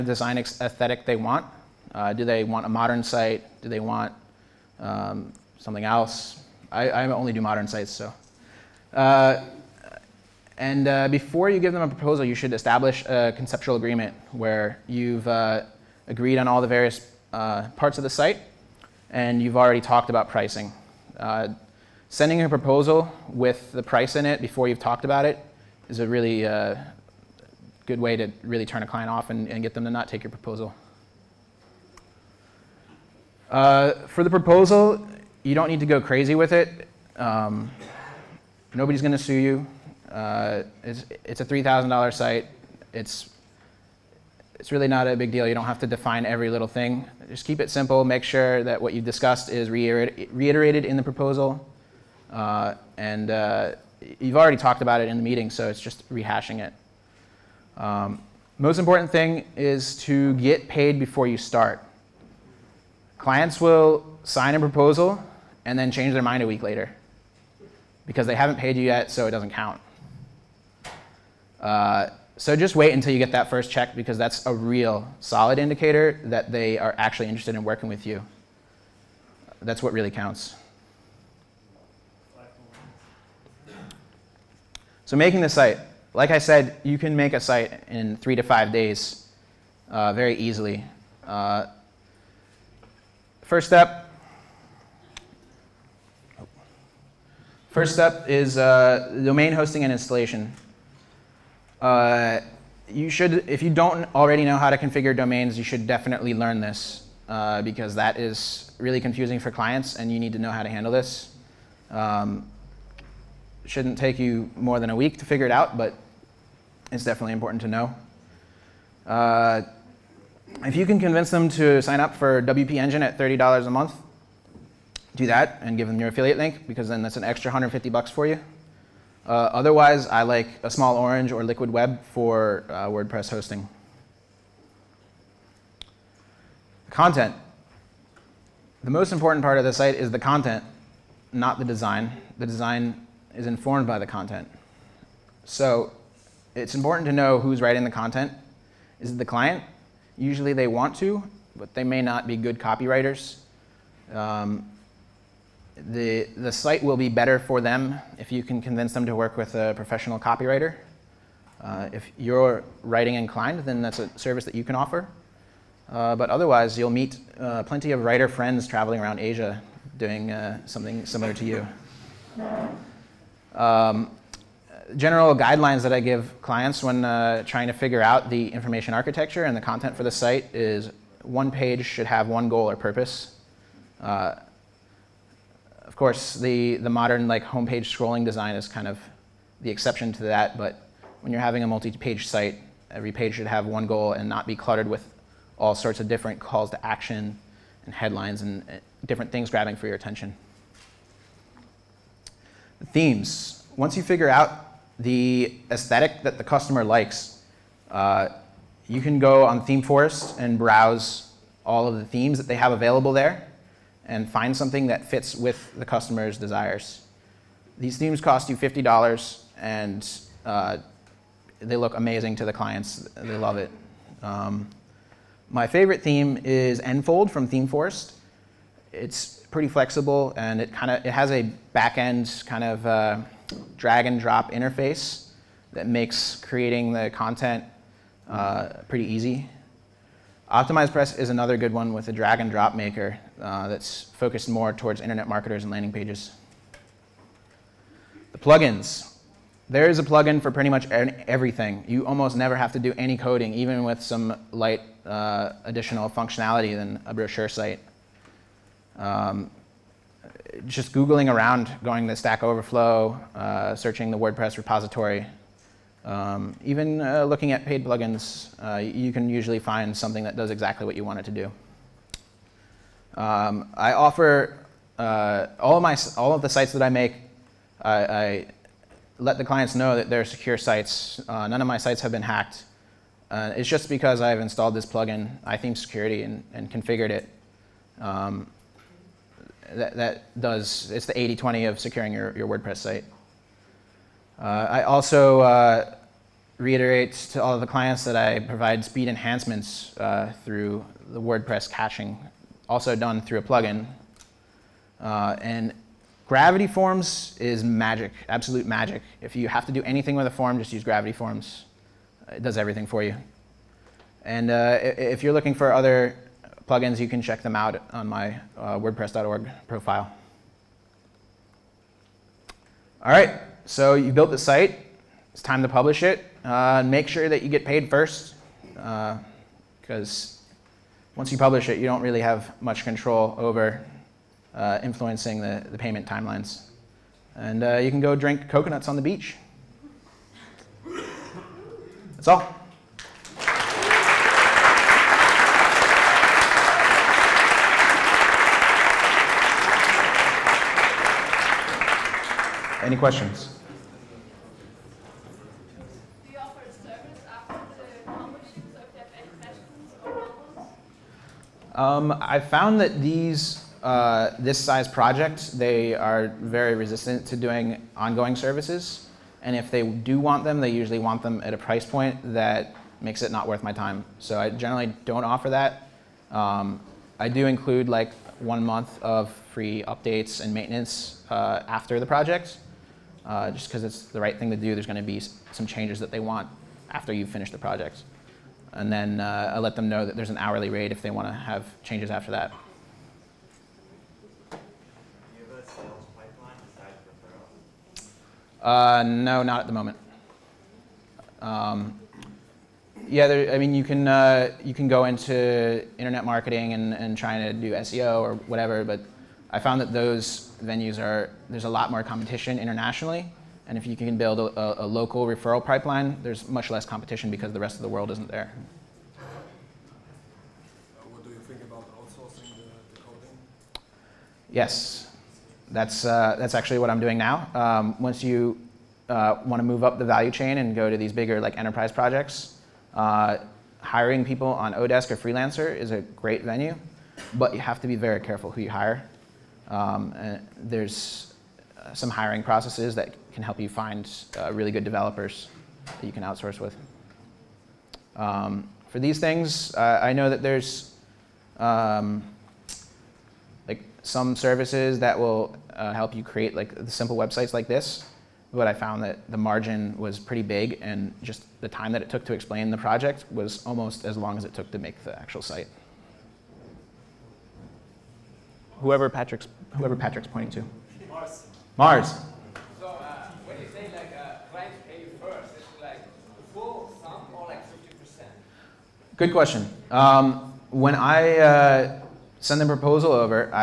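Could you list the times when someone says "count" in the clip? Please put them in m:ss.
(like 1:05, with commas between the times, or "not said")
1:09, 1:20.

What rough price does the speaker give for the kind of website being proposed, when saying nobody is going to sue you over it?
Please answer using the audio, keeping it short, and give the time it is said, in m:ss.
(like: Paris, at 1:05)
$3,000, at 0:41.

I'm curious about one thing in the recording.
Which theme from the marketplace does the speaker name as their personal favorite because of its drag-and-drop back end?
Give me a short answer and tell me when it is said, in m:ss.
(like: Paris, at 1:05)
Enfold, at 3:46.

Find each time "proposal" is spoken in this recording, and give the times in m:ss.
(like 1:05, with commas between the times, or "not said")
0:11, 0:22, 0:30, 0:34, 0:51, 1:04, 8:02.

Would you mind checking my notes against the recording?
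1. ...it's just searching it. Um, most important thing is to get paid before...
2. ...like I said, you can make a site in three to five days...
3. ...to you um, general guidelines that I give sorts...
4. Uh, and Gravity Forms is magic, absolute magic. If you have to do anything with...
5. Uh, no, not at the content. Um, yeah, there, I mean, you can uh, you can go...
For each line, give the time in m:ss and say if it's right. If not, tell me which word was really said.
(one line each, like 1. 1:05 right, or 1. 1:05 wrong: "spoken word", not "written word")
1. 0:55 wrong: "rehashing", not "searching"
2. 1:26 right
3. 2:51 wrong: "clients", not "sorts"
4. 5:04 right
5. 6:38 wrong: "moment", not "content".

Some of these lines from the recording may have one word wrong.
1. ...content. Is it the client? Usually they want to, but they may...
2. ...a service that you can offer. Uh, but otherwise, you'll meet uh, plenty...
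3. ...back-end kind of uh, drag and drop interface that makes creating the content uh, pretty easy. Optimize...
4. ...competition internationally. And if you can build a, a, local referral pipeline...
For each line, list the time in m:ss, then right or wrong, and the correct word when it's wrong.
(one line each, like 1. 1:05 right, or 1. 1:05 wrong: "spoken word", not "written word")
1. 2:27 right
2. 2:43 right
3. 3:51 right
4. 6:52 right.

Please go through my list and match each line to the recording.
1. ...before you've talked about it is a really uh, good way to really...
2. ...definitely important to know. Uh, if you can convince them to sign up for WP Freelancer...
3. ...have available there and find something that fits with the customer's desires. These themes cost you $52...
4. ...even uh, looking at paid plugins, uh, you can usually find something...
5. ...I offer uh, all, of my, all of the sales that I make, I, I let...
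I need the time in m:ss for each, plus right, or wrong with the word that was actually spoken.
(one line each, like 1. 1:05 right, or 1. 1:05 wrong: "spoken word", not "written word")
1. 0:24 right
2. 1:57 wrong: "Engine", not "Freelancer"
3. 3:32 wrong: "50", not "52"
4. 4:26 right
5. 4:33 wrong: "sites", not "sales".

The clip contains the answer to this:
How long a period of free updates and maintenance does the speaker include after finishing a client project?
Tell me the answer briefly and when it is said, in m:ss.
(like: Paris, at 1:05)
one month, at 6:18.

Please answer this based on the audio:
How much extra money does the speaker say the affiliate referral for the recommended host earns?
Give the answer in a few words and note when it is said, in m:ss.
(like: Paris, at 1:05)
150 bucks, at 2:07.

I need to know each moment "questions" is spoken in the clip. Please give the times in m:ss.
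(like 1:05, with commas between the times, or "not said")
5:52, 7:59.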